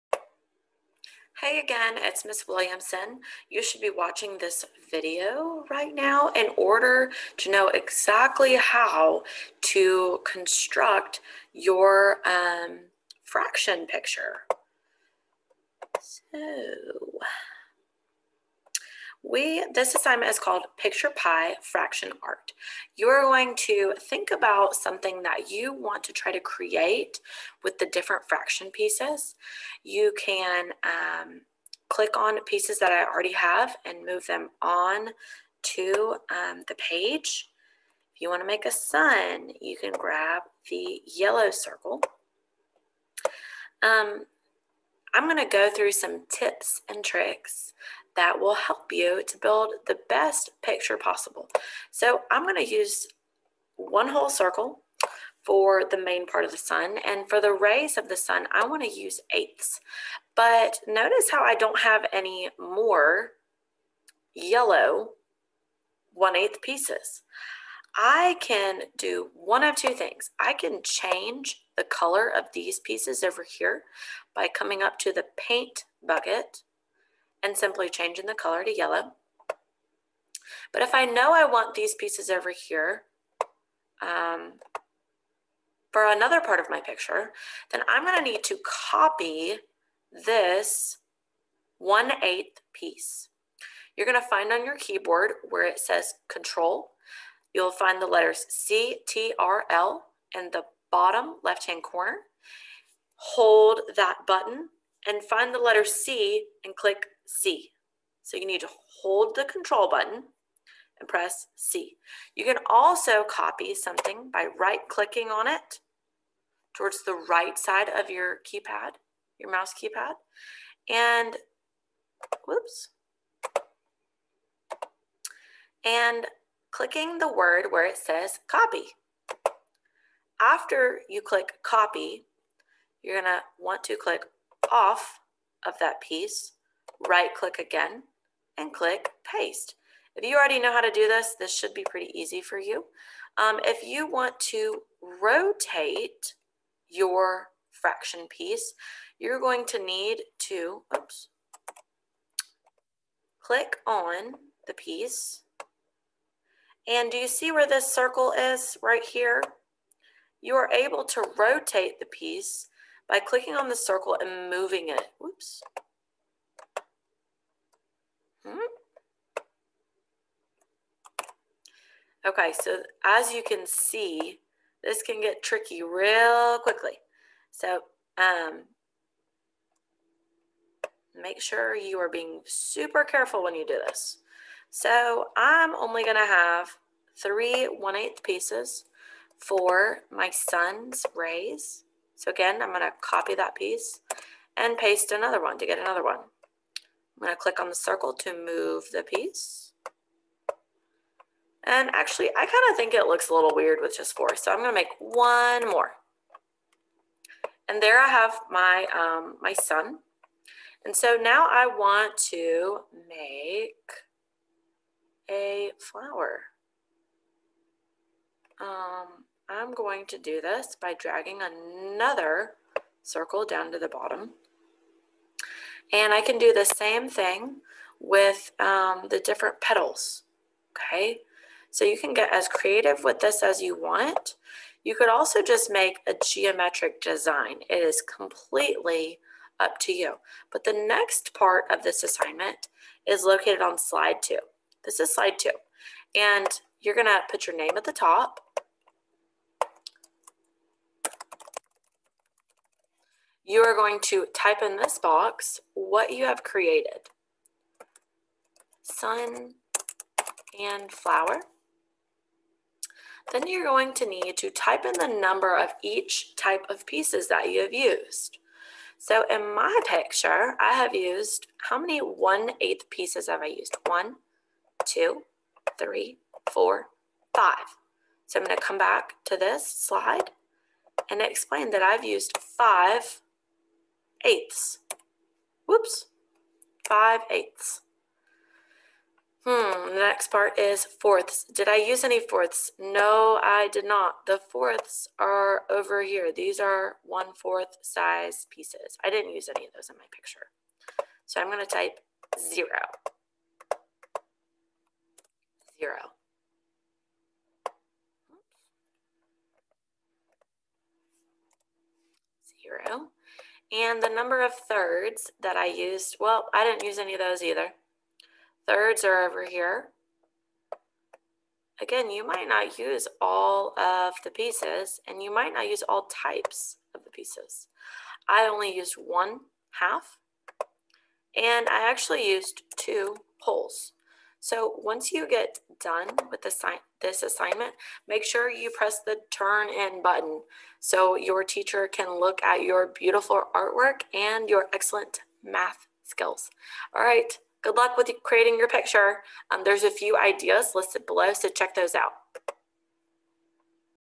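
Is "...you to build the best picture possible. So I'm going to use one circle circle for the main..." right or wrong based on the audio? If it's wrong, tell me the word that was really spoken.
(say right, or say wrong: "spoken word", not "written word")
wrong: "whole", not "circle".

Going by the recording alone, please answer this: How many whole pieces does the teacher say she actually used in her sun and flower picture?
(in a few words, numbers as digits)
2.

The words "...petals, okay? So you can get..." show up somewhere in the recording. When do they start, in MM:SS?
03:49.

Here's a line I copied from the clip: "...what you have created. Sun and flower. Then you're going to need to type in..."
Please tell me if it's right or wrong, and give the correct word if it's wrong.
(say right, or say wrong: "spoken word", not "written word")
right.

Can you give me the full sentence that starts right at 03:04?
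So I'm only gonna have three one eighth pieces for my sun's rays.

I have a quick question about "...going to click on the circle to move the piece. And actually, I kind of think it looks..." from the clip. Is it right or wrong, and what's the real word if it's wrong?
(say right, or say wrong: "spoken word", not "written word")
right.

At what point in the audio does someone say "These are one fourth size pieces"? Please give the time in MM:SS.
04:56.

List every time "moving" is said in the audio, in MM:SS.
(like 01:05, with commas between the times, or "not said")
02:44.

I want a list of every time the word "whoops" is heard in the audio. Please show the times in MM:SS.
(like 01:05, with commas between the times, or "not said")
02:02, 02:45, 04:45.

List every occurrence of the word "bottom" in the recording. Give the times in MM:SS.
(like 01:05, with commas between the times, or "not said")
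01:40, 03:43.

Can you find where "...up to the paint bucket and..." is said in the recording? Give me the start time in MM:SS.
01:14.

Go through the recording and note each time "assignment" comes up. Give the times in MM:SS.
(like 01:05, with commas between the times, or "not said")
00:19, 04:02, 05:37.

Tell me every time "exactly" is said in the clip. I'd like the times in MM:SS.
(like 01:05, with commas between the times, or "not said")
00:07.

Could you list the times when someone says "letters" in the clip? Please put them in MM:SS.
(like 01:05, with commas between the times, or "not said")
01:38, 01:45.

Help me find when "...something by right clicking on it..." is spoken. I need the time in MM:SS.
01:53.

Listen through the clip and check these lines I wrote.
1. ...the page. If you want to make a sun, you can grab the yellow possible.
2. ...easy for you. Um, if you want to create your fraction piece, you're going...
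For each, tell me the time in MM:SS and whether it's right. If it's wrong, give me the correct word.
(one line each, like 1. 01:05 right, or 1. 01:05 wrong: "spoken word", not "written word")
1. 00:36 wrong: "circle", not "possible"
2. 02:22 wrong: "rotate", not "create".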